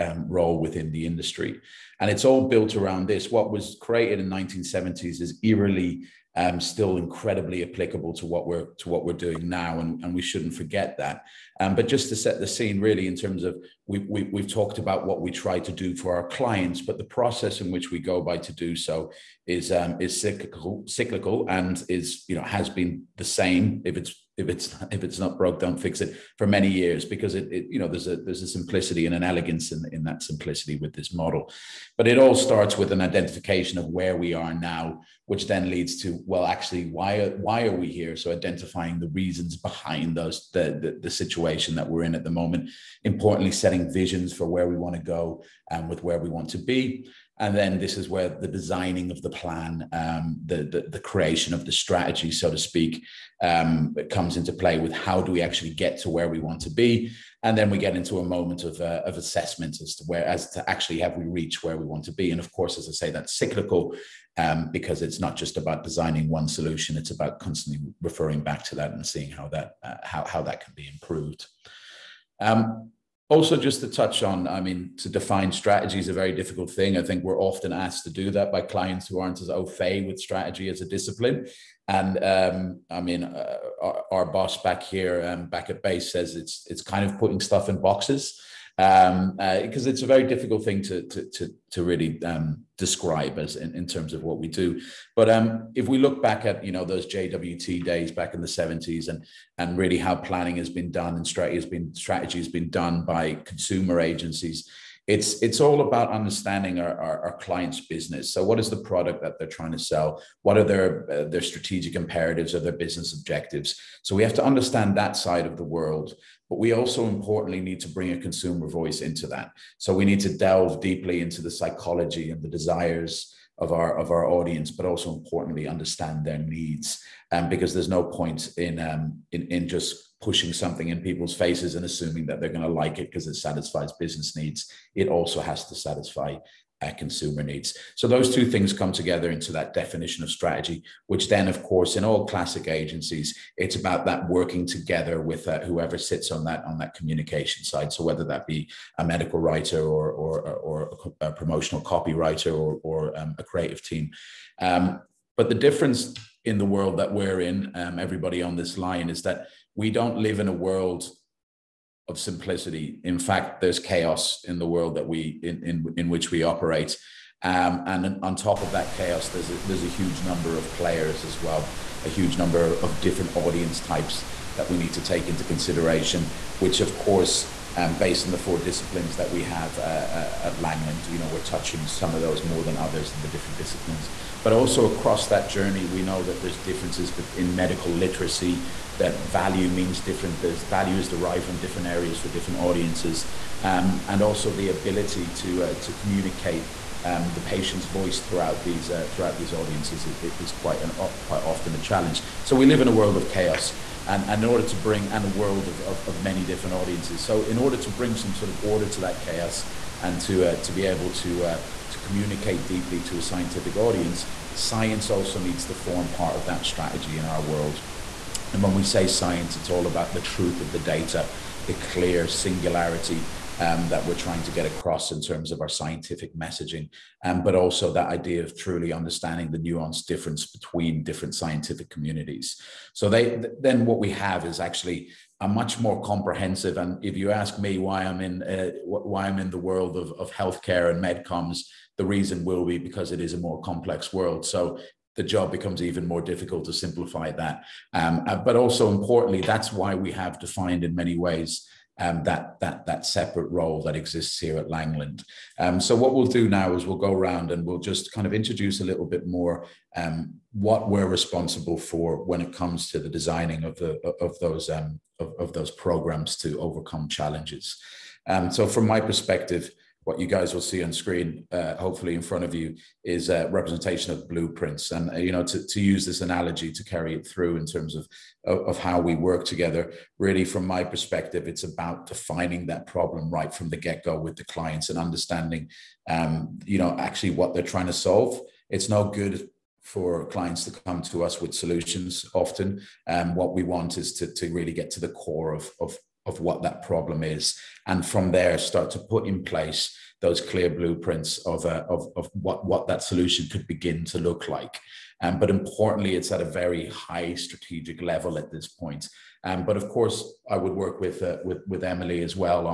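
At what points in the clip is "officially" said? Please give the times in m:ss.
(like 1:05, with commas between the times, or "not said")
not said.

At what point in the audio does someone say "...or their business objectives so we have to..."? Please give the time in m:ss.
1:52.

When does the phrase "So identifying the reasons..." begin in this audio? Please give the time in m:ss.
0:38.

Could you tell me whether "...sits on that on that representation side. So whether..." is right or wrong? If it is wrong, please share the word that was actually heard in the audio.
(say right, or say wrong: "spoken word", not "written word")
wrong: "communication", not "representation".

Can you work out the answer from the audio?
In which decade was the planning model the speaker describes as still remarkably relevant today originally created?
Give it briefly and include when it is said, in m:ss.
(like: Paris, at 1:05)
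1970s, at 0:04.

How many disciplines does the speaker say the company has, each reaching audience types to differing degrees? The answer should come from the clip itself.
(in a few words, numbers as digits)
4.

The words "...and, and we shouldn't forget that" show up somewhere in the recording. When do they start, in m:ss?
0:09.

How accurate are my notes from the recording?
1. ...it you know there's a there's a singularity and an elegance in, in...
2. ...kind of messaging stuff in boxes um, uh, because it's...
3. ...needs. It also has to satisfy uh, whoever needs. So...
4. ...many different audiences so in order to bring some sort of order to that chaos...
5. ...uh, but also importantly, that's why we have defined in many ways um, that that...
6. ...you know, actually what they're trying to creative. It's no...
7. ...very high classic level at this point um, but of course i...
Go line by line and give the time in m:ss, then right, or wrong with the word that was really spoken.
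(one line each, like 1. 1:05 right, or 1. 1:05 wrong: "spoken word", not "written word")
1. 0:27 wrong: "simplicity", not "singularity"
2. 1:26 wrong: "putting", not "messaging"
3. 2:14 wrong: "consumer", not "whoever"
4. 3:26 right
5. 4:08 right
6. 4:46 wrong: "solve", not "creative"
7. 5:06 wrong: "strategic", not "classic".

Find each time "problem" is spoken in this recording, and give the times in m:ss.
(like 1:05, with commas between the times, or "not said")
4:42, 4:56.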